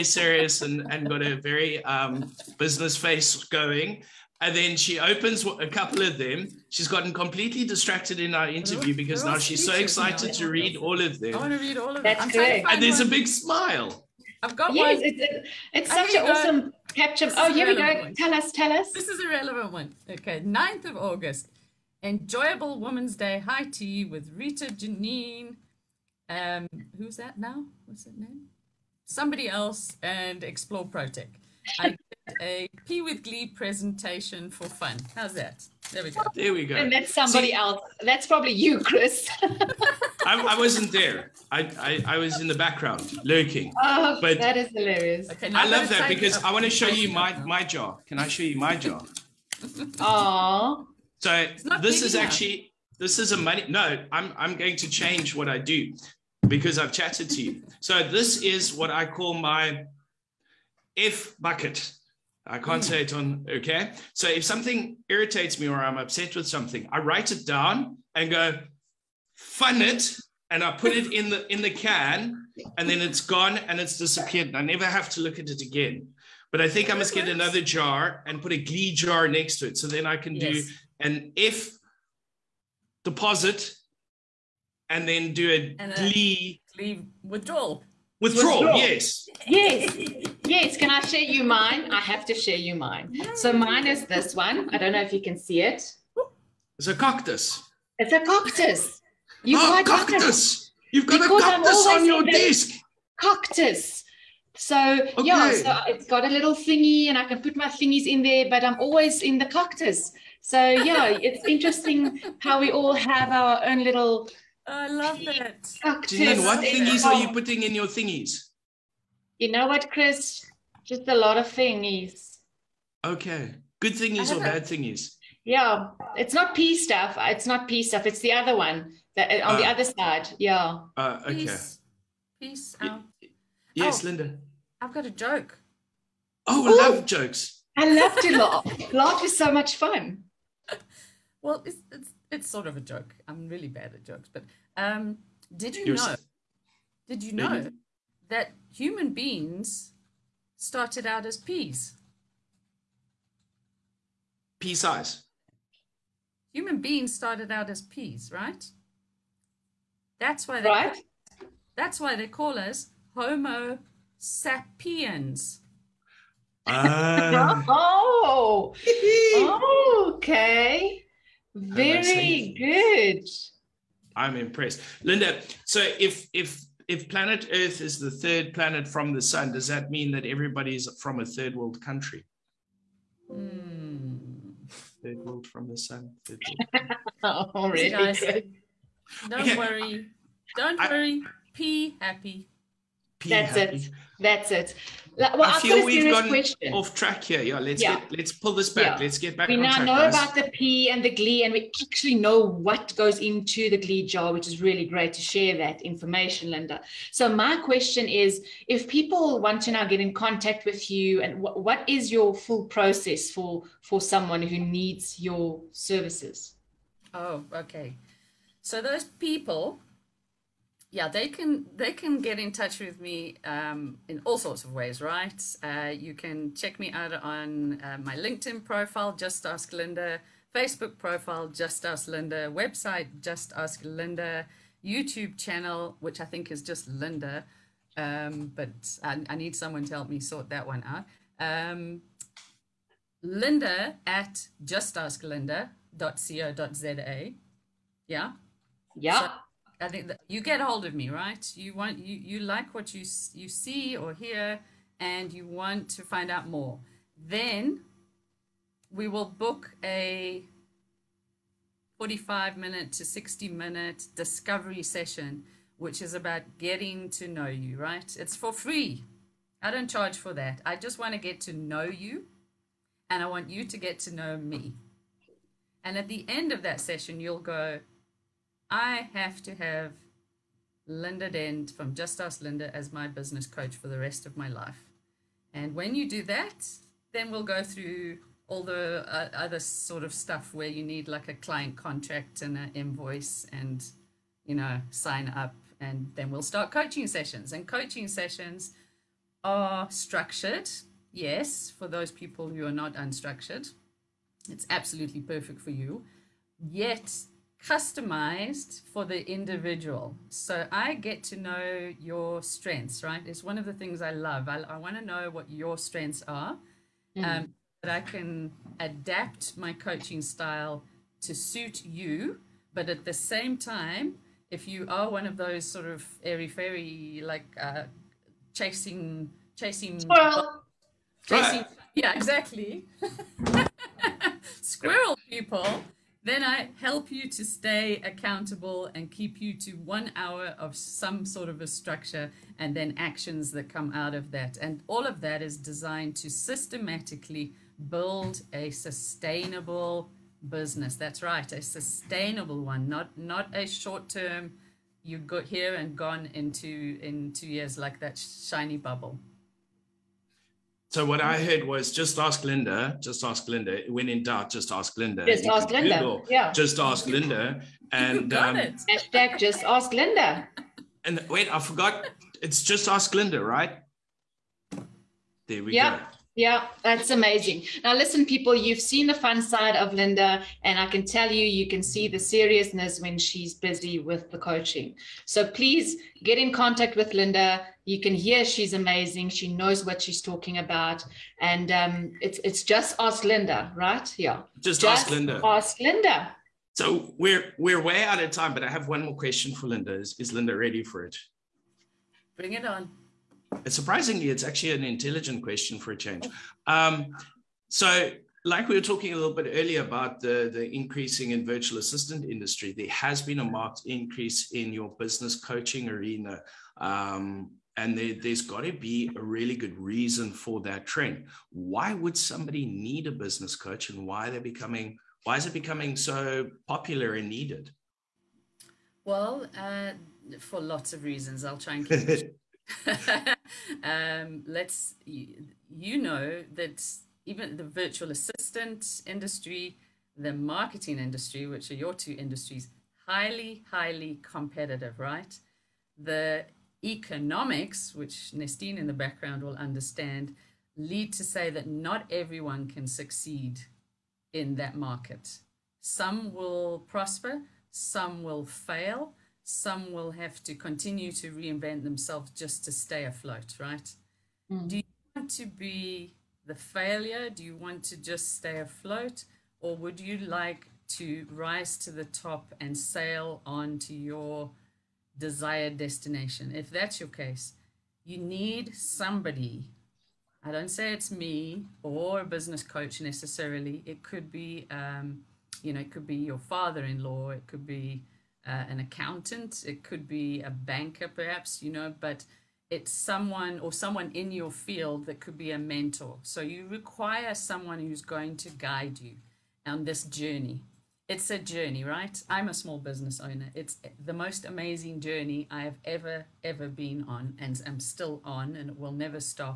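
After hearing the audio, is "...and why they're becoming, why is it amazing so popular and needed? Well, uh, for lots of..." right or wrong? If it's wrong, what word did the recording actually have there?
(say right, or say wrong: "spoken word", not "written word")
wrong: "becoming", not "amazing".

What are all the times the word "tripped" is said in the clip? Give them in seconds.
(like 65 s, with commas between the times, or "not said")
not said.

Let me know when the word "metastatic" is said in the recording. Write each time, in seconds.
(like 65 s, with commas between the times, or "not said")
not said.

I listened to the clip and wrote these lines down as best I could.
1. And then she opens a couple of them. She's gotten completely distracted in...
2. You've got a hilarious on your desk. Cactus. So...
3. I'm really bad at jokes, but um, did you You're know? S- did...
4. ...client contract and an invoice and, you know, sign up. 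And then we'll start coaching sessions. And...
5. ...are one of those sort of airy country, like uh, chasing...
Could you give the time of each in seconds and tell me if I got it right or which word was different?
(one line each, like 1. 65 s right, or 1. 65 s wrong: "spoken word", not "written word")
1. 4 s right
2. 100 s wrong: "cactus", not "hilarious"
3. 143 s right
4. 291 s right
5. 324 s wrong: "fairy", not "country".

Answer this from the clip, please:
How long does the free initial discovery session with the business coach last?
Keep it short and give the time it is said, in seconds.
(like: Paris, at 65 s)
45 to 60 minutes, at 261 s.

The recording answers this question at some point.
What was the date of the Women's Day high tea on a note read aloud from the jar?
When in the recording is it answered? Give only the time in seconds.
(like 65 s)
20 s.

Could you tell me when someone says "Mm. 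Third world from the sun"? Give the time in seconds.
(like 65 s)
183 s.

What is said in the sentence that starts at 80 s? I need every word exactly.
do an F deposit and then do a, and a glee, glee withdrawal.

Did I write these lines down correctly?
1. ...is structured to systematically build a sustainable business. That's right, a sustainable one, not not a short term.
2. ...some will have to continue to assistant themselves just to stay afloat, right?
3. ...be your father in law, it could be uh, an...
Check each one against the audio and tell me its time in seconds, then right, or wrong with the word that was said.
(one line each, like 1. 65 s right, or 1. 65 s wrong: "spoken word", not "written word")
1. 345 s wrong: "designed", not "structured"
2. 459 s wrong: "reinvent", not "assistant"
3. 486 s right.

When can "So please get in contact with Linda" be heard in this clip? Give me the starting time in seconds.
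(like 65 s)
385 s.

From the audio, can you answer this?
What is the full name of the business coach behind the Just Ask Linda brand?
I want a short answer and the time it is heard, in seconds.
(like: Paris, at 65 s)
Linda Dent, at 280 s.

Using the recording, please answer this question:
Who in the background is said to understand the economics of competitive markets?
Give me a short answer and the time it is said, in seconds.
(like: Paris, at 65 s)
Nastine, at 448 s.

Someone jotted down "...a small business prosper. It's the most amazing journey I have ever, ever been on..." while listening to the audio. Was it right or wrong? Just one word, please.
wrong.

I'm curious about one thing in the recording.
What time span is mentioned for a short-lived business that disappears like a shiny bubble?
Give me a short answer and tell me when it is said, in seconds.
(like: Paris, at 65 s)
Two years, at 357 s.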